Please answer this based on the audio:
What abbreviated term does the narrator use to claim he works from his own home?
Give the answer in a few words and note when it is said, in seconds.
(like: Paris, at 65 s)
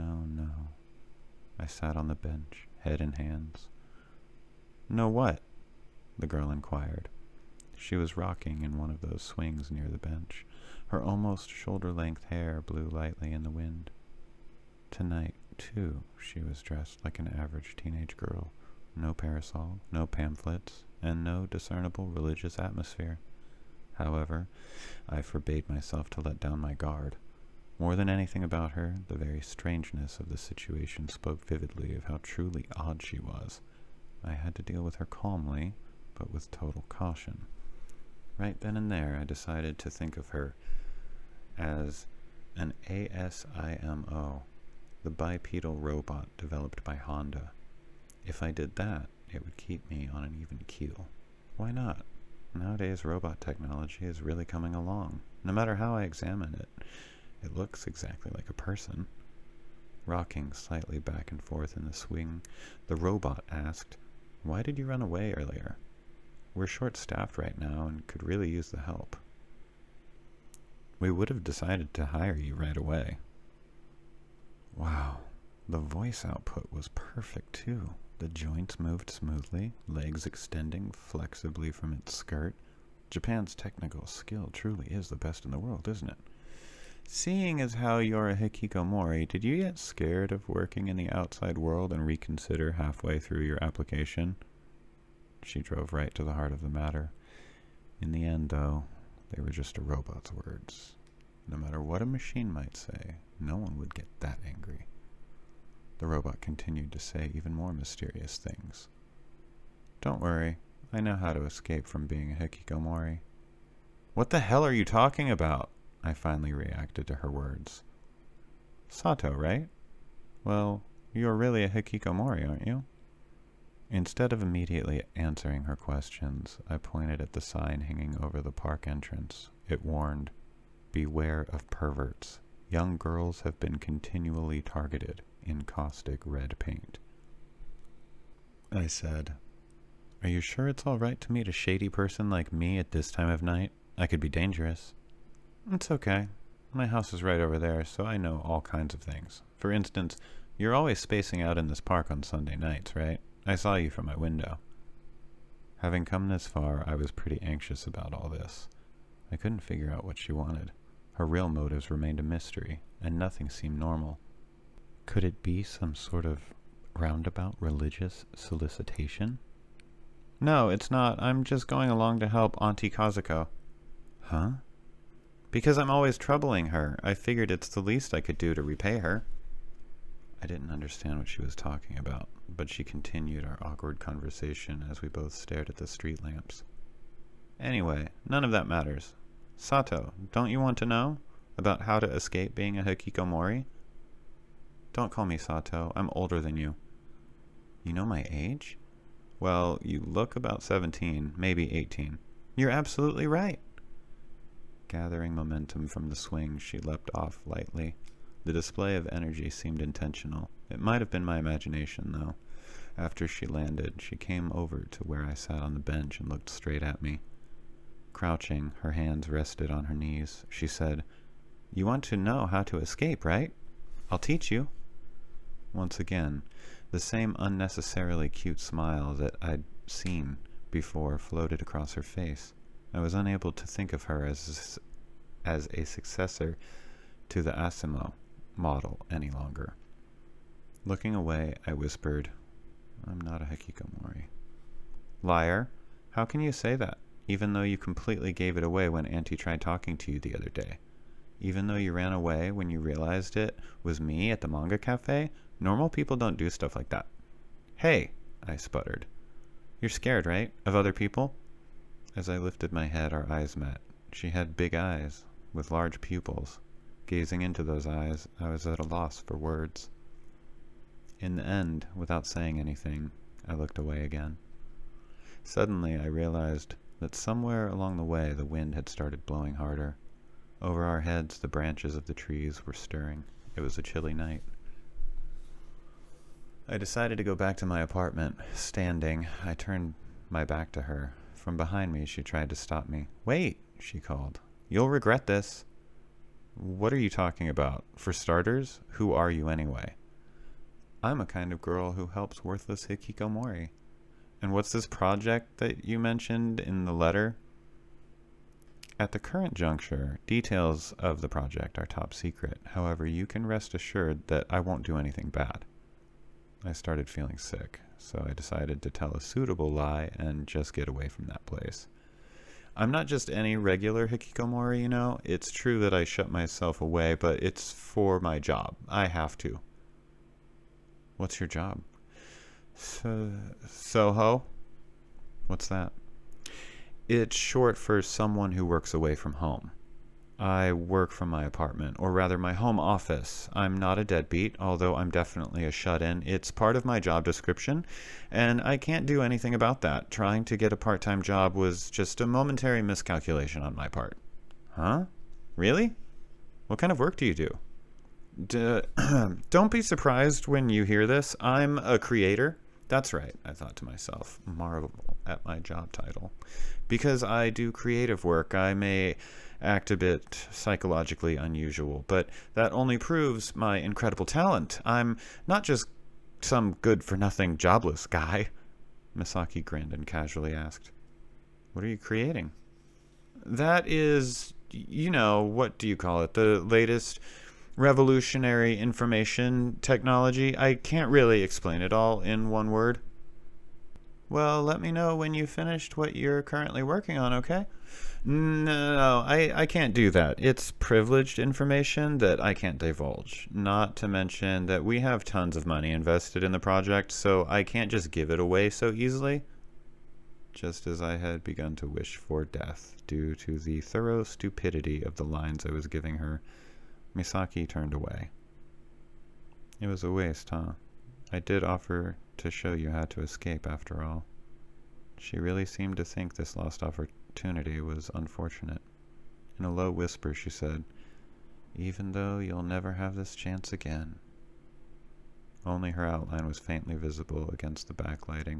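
Soho, at 333 s.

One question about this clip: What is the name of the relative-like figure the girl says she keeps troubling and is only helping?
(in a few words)
Auntie Kazuko.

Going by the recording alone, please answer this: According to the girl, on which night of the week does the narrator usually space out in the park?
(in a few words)
Sunday.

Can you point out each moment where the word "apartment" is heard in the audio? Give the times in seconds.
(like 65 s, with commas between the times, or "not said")
287 s, 341 s.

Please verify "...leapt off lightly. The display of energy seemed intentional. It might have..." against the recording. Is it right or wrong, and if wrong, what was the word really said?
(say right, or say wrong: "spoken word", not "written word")
right.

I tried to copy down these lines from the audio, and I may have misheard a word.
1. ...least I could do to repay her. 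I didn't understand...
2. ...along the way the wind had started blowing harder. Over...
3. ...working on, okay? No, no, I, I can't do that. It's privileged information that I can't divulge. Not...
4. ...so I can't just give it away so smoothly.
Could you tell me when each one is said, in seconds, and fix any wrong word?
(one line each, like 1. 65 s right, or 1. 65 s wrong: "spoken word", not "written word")
1. 177 s right
2. 277 s right
3. 396 s right
4. 407 s wrong: "easily", not "smoothly".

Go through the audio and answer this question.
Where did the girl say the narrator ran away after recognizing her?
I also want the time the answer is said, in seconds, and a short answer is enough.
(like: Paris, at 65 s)
manga cafe, at 254 s.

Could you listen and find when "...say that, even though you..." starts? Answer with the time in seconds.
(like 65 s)
246 s.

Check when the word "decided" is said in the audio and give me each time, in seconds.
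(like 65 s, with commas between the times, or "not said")
39 s, 71 s, 286 s, 318 s.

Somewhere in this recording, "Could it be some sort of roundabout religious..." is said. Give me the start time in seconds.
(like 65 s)
165 s.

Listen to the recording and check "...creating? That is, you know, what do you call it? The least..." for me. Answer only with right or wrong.
wrong.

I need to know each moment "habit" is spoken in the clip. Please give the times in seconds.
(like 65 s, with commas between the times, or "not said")
not said.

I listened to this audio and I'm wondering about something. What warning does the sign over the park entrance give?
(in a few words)
Beware of perverts.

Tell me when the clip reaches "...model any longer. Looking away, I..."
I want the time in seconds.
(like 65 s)
238 s.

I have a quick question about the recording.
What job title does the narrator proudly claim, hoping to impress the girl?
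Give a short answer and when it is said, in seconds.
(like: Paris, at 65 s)
creator, at 361 s.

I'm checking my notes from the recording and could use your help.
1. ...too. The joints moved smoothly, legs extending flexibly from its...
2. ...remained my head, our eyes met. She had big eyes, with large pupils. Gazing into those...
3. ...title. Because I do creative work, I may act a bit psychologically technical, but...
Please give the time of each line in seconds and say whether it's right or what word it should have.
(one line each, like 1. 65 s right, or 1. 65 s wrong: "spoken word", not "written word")
1. 77 s right
2. 262 s wrong: "lifted", not "remained"
3. 365 s wrong: "unusual", not "technical".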